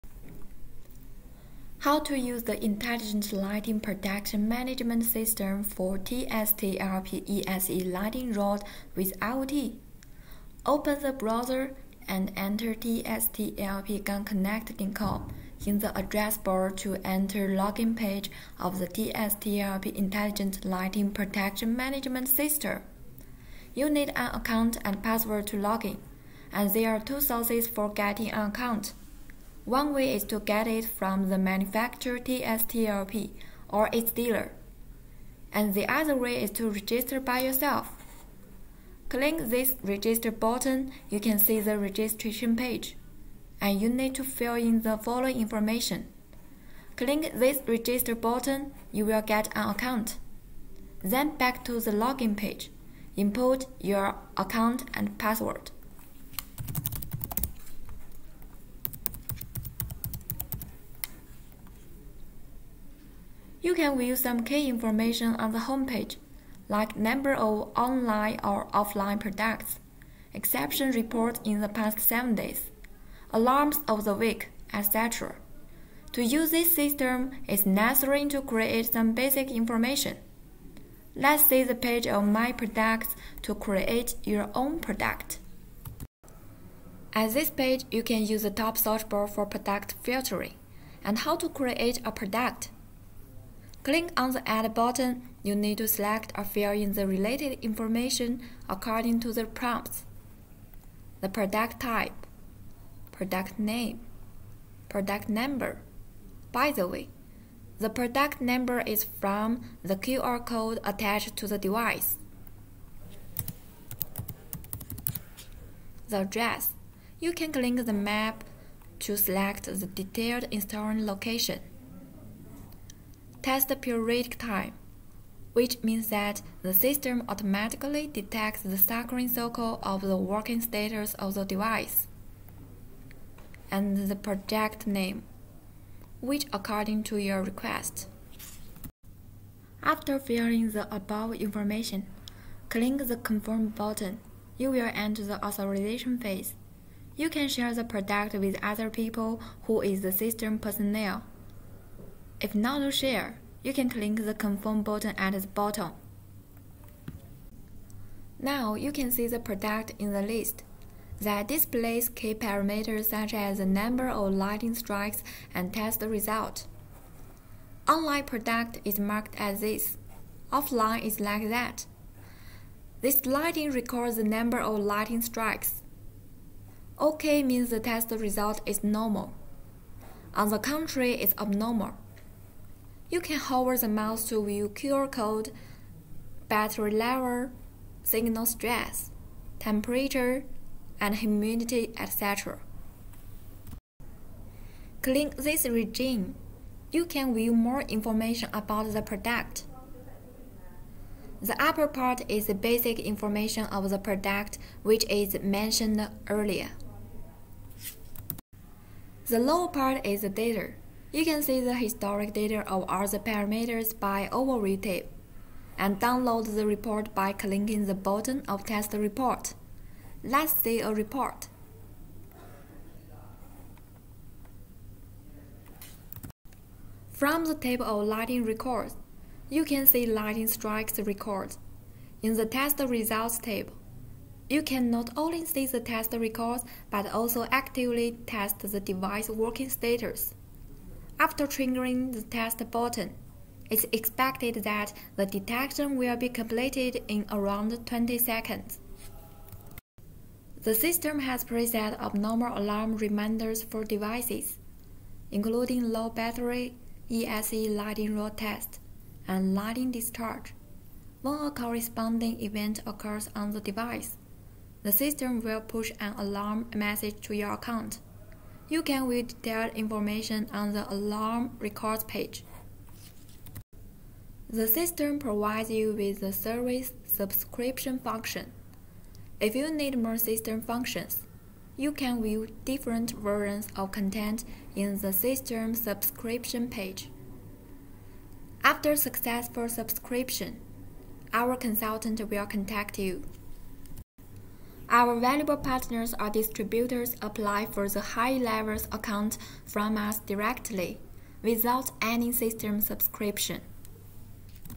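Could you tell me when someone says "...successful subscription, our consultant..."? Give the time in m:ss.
4:48.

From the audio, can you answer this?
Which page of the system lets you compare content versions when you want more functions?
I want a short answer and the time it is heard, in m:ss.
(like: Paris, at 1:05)
system subscription page, at 4:45.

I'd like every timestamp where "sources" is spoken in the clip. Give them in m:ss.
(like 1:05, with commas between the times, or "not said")
0:27.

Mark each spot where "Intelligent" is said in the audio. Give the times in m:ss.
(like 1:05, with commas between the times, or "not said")
0:02, 0:19.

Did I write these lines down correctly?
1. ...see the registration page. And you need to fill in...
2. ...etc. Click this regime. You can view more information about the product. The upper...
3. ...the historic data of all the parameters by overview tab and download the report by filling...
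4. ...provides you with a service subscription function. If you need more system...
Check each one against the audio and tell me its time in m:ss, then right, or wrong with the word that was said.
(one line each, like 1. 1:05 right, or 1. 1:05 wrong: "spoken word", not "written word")
1. 0:41 right
2. 3:11 right
3. 3:31 wrong: "clicking", not "filling"
4. 4:35 right.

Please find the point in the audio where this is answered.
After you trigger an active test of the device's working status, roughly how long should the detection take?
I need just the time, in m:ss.
4:07.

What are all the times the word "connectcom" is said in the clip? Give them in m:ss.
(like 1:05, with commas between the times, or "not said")
0:12.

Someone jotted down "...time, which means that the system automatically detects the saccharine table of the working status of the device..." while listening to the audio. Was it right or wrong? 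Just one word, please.
wrong.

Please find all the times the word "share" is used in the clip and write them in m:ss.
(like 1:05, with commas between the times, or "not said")
2:27, 2:32.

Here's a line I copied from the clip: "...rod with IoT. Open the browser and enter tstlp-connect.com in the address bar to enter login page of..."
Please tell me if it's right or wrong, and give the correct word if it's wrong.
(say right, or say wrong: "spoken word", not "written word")
right.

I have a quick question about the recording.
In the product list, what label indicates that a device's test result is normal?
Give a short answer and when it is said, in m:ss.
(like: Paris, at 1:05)
OK, at 2:56.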